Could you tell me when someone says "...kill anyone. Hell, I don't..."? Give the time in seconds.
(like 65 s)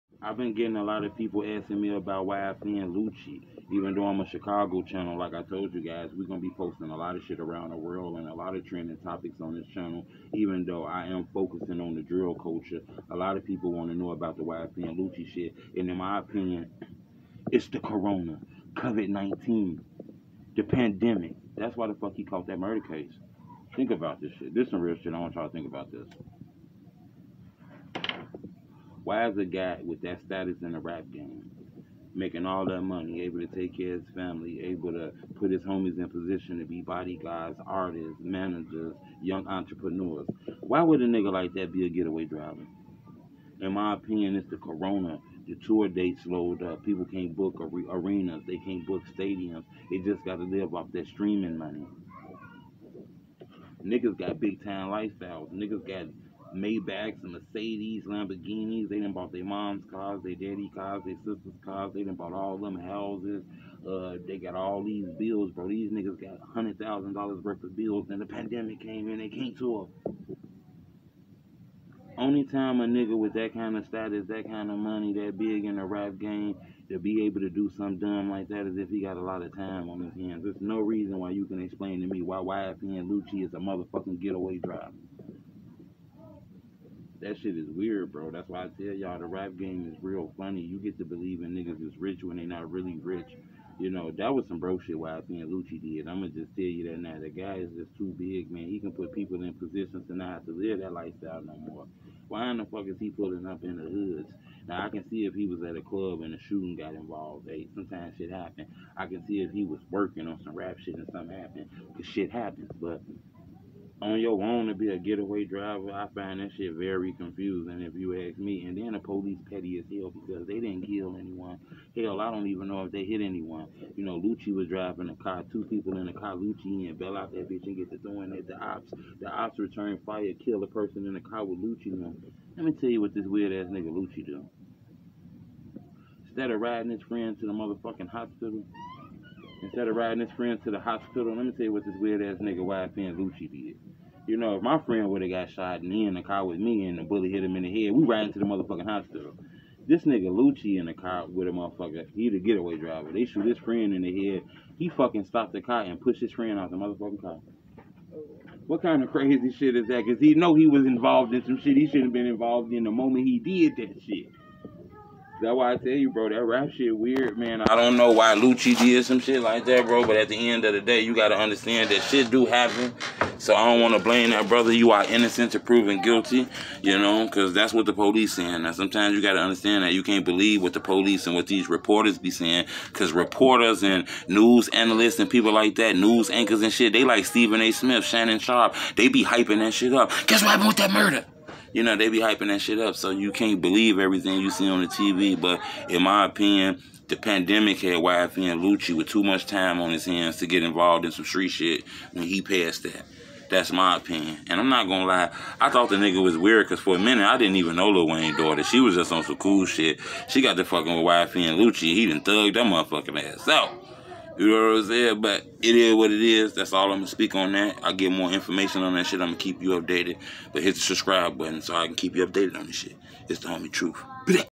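120 s.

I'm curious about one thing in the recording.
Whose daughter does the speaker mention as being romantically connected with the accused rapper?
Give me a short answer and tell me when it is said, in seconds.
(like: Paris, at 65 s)
Lil Wayne, at 207 s.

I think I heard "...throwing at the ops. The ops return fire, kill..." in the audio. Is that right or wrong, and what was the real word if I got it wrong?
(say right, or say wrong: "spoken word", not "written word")
right.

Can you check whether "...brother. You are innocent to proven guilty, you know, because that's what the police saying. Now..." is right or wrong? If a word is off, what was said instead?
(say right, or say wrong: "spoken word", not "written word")
right.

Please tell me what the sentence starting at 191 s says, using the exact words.
you know, they be hyping that shit up.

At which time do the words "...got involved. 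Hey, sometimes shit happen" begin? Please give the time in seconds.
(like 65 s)
106 s.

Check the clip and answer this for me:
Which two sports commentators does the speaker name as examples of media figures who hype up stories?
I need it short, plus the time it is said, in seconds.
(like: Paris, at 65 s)
Stephen A. Smith, Shannon Sharpe, at 187 s.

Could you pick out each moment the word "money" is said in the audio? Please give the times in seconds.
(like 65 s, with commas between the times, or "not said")
32 s, 51 s, 74 s.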